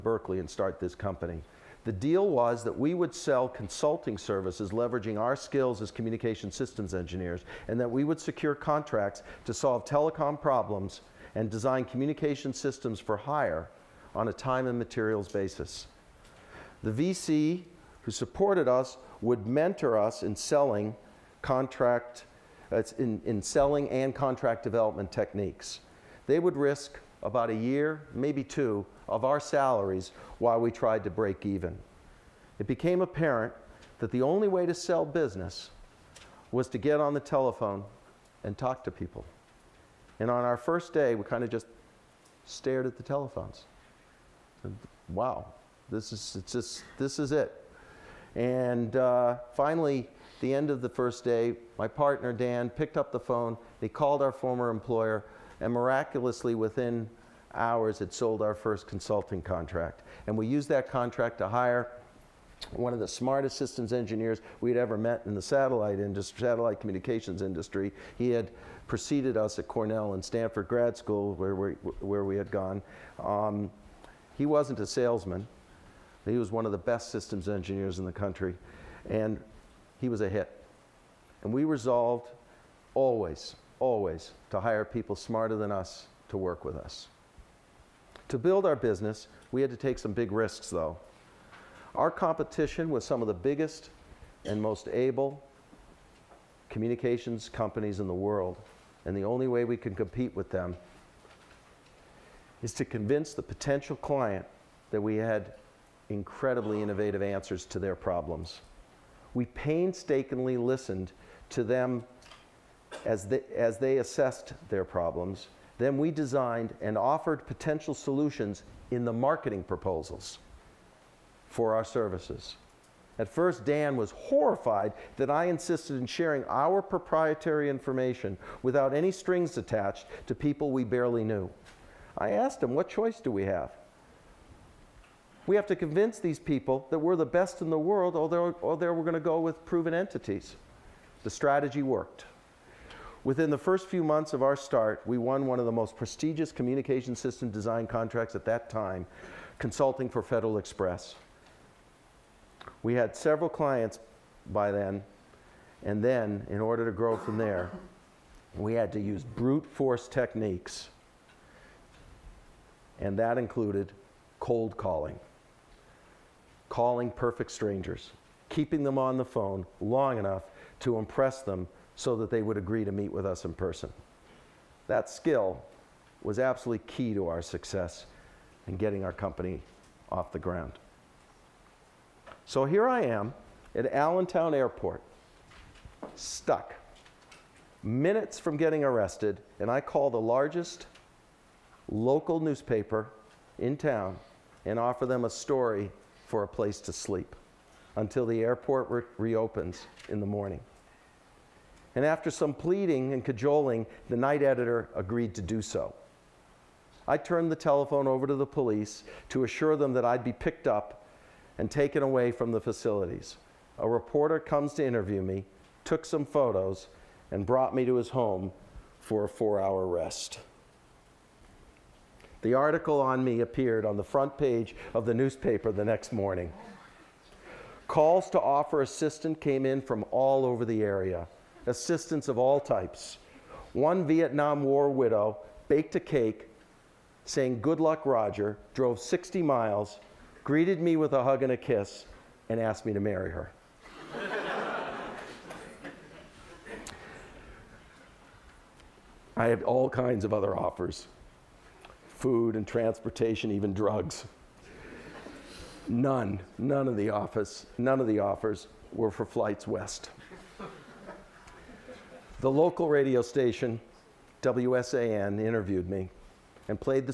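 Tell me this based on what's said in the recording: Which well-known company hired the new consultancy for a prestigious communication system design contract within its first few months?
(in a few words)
Federal Express.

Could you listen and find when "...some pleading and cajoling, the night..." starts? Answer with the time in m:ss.
3:22.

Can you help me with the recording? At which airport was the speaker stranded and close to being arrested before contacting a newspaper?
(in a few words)
Allentown Airport.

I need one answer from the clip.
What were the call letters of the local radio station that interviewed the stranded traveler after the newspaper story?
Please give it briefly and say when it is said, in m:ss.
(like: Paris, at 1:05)
WSAN, at 4:24.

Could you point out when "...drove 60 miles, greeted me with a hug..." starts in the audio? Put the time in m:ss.
3:58.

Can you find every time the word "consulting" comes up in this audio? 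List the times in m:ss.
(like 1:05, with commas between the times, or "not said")
0:03, 0:58, 2:29.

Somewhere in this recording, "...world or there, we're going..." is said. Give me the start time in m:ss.
2:17.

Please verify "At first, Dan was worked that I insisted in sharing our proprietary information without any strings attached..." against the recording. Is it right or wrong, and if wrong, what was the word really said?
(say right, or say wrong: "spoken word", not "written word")
wrong: "horrified", not "worked".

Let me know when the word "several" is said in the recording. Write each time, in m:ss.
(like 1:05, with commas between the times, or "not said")
2:33.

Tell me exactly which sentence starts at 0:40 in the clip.
And on our first day, we kind of just stared at the telephones.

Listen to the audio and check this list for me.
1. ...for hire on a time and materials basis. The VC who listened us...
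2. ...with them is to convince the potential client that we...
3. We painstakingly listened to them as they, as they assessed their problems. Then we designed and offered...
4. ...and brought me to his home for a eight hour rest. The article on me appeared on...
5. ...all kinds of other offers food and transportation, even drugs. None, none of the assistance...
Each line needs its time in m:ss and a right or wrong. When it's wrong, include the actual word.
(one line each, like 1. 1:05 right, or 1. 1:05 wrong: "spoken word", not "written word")
1. 0:13 wrong: "supported", not "listened"
2. 1:40 right
3. 1:49 right
4. 3:37 wrong: "four", not "eight"
5. 4:09 wrong: "office", not "assistance".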